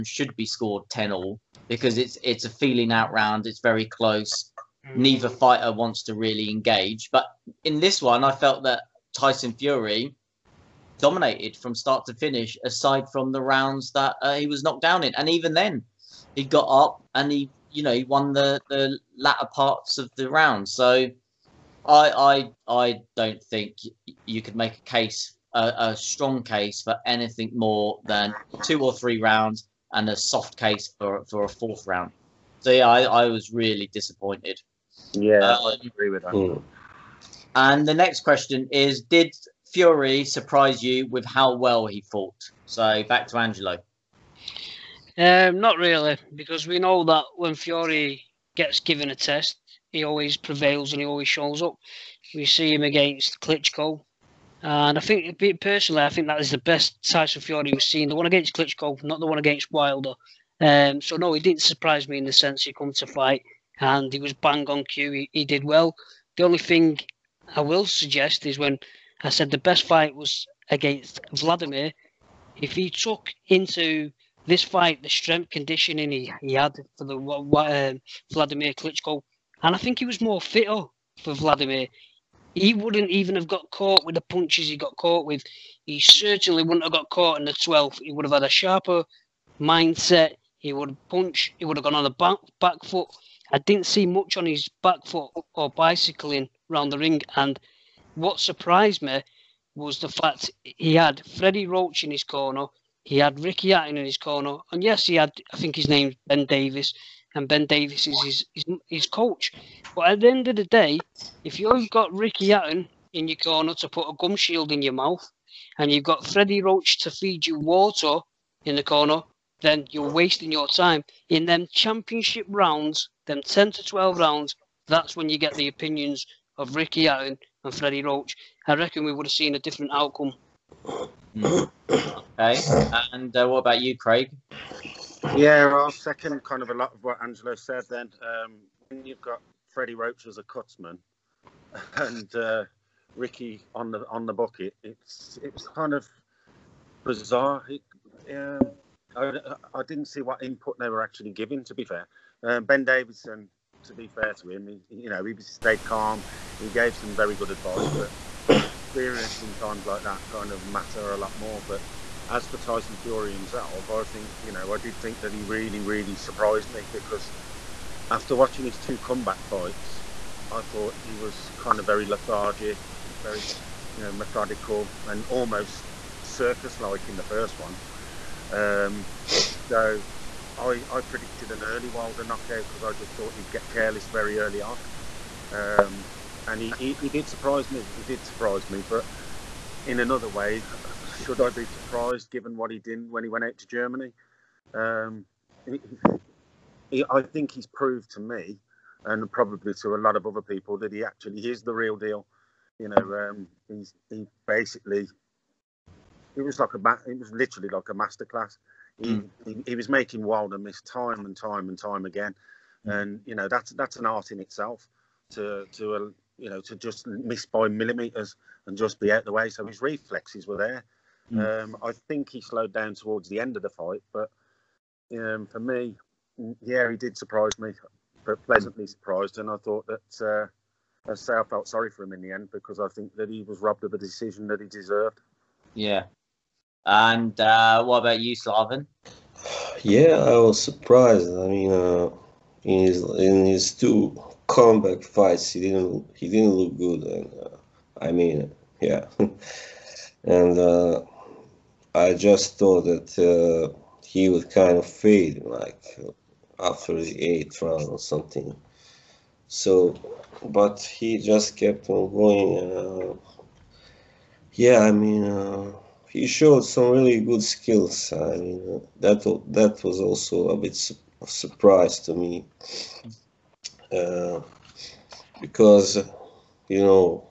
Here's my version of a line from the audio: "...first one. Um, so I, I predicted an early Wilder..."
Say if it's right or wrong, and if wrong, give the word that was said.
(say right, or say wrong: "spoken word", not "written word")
right.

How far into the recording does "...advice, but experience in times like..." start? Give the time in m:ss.
2:37.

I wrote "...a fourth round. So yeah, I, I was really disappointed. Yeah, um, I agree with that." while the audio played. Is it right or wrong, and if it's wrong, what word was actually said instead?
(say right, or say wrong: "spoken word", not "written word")
right.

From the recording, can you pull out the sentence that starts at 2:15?
Yeah, I'll second kind of a lot of what Angelo said then.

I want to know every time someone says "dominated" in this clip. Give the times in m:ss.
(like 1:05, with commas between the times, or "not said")
0:10.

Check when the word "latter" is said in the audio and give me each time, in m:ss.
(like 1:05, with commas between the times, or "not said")
0:19.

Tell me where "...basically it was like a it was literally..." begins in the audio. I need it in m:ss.
3:24.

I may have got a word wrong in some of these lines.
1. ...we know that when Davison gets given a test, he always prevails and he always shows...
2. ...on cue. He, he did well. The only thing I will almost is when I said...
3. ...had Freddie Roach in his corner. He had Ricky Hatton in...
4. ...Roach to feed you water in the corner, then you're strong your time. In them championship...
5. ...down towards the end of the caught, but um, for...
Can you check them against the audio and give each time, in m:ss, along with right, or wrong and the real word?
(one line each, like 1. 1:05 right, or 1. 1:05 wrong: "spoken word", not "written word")
1. 0:46 wrong: "Fury", not "Davison"
2. 1:04 wrong: "suggest", not "almost"
3. 1:40 right
4. 1:56 wrong: "wasting", not "strong"
5. 3:42 wrong: "fight", not "caught".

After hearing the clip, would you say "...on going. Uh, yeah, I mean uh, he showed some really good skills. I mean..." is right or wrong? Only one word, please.
right.